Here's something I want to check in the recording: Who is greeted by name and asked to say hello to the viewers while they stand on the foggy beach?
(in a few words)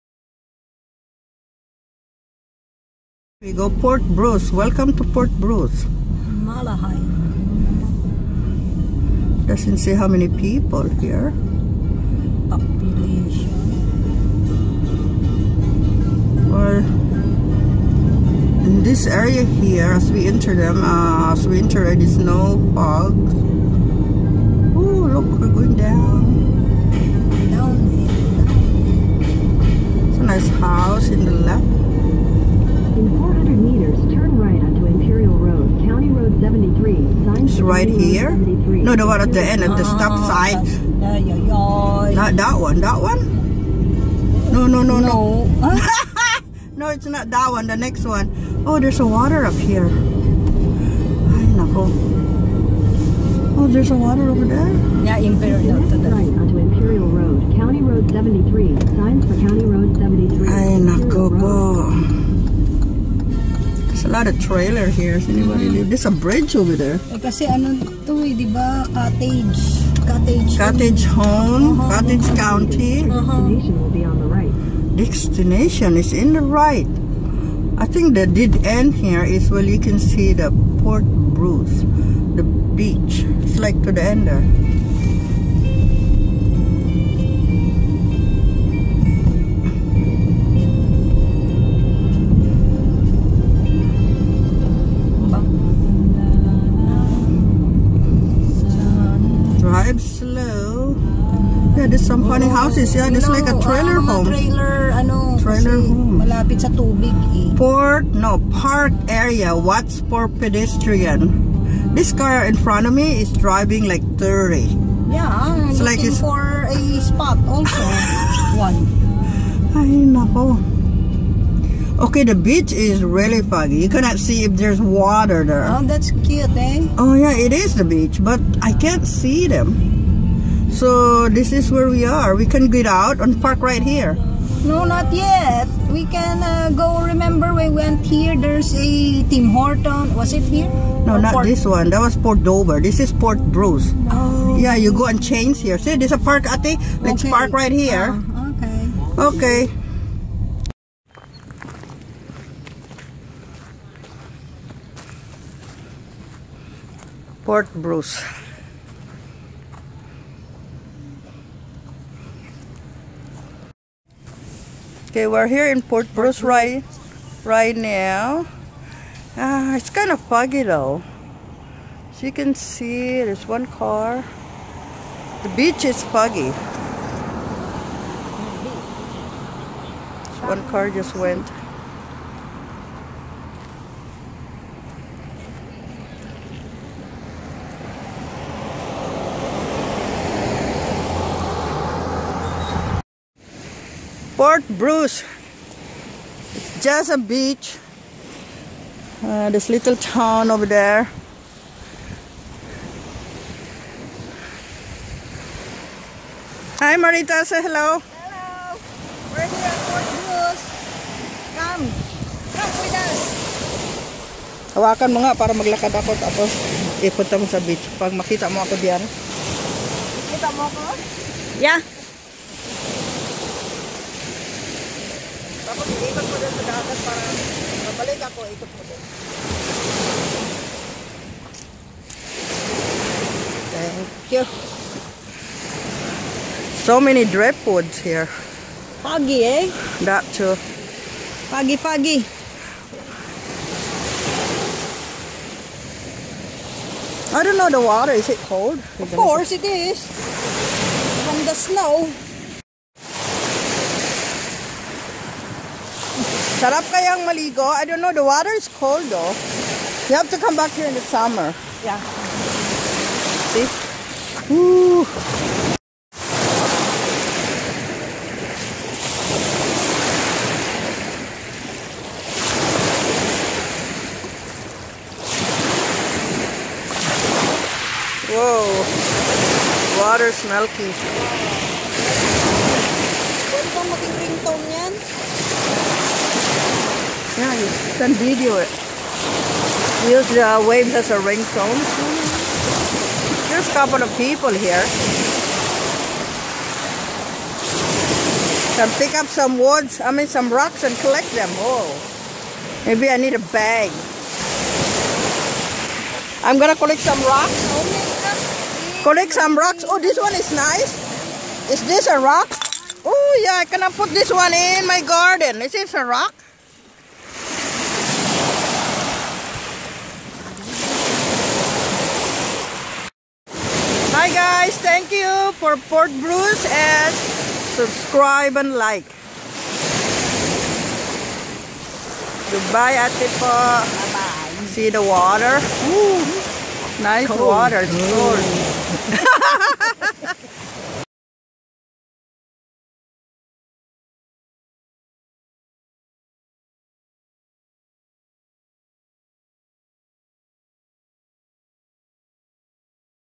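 Marita.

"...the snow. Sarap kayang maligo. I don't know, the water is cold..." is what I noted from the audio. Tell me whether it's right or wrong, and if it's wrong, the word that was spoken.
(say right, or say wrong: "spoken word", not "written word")
right.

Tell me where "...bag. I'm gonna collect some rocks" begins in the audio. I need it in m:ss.
5:03.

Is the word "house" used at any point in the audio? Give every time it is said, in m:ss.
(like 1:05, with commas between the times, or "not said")
0:30, 1:42.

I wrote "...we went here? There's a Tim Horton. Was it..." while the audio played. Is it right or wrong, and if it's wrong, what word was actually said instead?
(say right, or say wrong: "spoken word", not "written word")
right.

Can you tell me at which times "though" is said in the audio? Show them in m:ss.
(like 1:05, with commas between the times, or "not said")
2:50, 4:19.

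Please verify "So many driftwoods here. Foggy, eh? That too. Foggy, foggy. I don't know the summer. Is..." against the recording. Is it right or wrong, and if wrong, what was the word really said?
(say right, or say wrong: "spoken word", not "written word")
wrong: "water", not "summer".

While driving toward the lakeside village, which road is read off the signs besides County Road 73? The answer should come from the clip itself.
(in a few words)
Imperial Road.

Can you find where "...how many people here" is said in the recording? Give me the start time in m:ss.
0:09.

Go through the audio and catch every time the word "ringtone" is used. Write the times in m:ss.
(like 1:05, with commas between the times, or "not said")
4:44, 4:51.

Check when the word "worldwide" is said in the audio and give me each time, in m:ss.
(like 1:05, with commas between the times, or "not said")
not said.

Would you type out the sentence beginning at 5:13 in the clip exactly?
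Oh yeah, can I put this one in my garden?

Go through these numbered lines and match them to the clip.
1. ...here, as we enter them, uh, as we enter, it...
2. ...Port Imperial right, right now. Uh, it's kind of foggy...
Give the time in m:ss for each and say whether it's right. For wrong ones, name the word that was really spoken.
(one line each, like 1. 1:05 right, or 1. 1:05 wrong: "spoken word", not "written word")
1. 0:19 right
2. 2:45 wrong: "Bruce", not "Imperial".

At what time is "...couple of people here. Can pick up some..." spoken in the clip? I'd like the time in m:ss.
4:53.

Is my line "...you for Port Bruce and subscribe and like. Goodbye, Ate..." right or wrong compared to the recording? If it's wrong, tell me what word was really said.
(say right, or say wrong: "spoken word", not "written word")
right.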